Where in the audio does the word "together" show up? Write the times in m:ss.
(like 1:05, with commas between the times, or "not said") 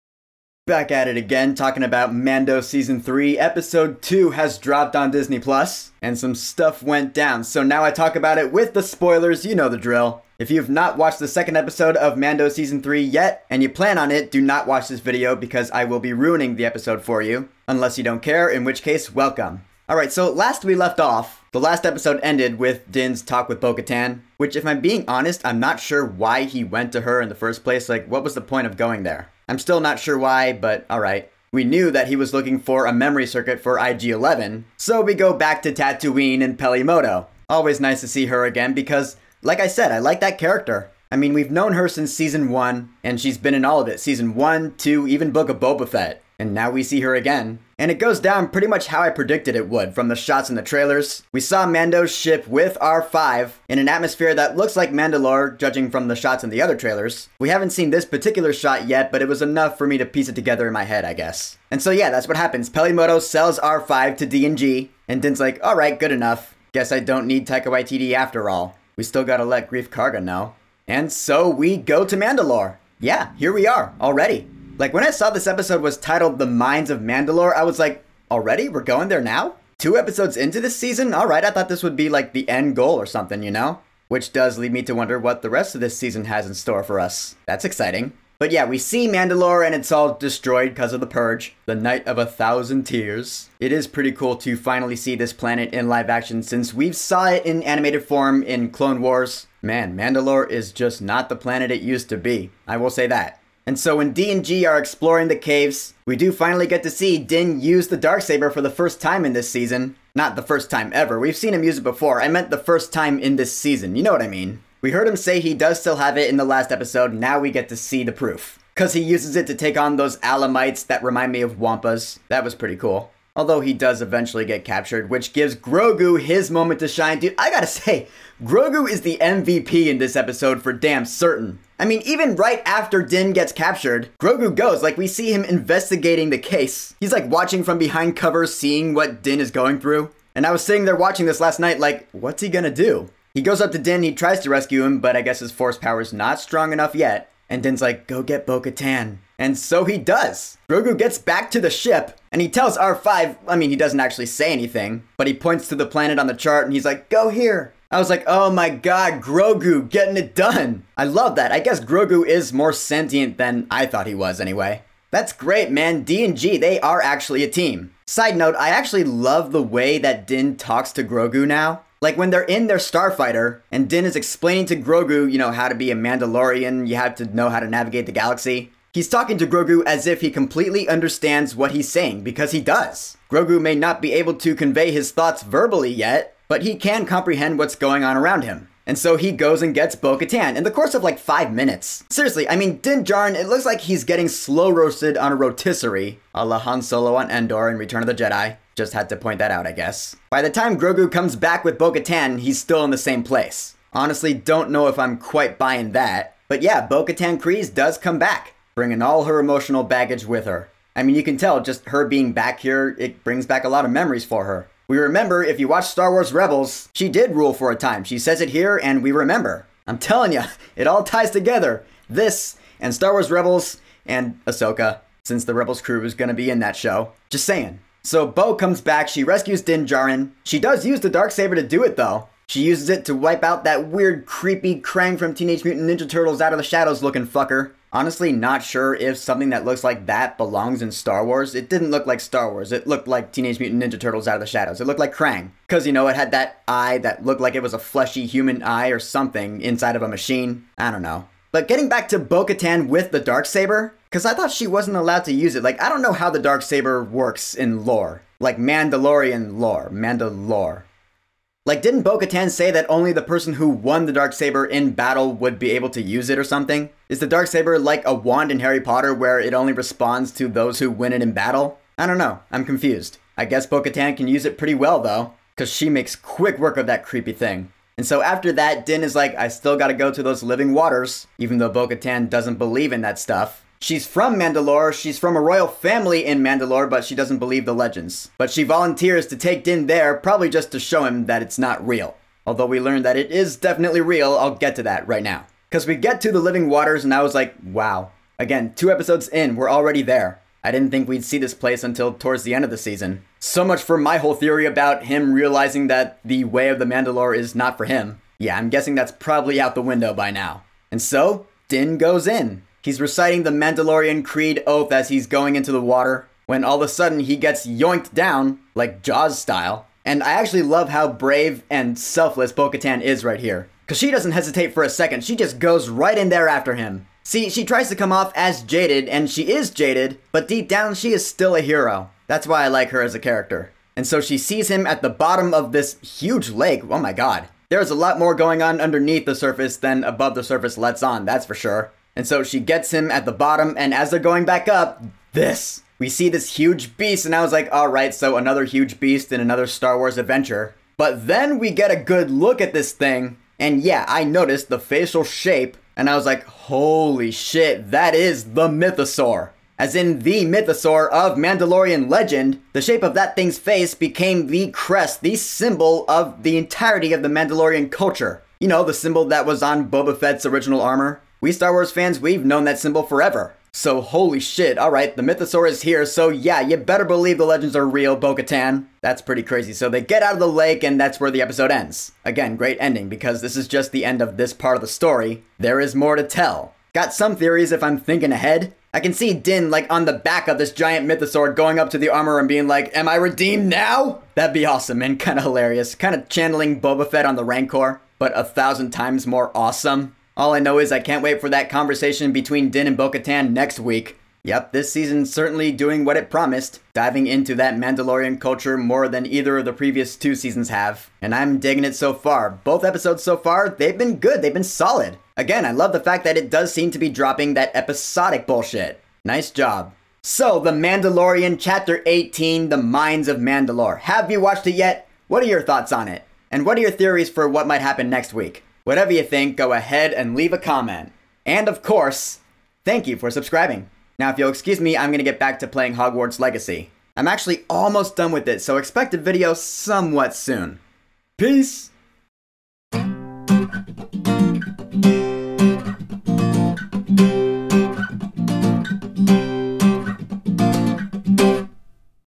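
1:00, 3:41.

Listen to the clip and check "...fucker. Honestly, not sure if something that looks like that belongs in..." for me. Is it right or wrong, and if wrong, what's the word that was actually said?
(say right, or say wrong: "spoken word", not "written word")
right.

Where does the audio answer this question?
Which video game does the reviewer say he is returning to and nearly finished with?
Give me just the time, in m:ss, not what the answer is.
7:15.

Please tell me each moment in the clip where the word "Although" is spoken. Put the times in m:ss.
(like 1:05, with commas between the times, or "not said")
2:03, 4:52.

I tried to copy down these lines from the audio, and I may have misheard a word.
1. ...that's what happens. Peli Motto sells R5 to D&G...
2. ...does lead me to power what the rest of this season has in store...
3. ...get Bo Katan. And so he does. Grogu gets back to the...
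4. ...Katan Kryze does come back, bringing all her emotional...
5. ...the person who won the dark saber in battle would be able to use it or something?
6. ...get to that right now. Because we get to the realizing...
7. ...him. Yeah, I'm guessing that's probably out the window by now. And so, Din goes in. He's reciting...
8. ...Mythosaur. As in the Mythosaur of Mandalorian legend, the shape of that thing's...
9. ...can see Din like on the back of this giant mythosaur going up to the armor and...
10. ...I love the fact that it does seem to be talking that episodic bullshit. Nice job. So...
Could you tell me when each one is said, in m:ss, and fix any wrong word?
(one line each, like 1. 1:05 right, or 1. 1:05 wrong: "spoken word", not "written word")
1. 1:02 right
2. 1:24 wrong: "wonder", not "power"
3. 2:28 right
4. 3:27 right
5. 4:23 right
6. 4:54 wrong: "living", not "realizing"
7. 5:07 right
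8. 5:58 right
9. 6:28 right
10. 6:55 wrong: "dropping", not "talking".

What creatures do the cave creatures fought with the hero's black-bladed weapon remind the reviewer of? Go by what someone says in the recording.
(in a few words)
Wampas.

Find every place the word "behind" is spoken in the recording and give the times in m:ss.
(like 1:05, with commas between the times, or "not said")
2:17.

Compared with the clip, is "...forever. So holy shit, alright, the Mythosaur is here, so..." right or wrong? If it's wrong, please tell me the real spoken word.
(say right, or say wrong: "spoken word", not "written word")
right.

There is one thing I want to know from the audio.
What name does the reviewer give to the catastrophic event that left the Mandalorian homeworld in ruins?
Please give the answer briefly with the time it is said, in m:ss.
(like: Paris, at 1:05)
Night of a Thousand Tears, at 1:31.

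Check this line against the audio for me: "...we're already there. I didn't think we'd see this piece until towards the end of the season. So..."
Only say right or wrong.
wrong.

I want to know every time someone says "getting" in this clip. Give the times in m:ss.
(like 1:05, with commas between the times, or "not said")
2:39, 3:14, 4:11.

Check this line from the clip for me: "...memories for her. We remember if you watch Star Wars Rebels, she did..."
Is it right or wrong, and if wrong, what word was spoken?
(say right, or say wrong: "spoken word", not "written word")
right.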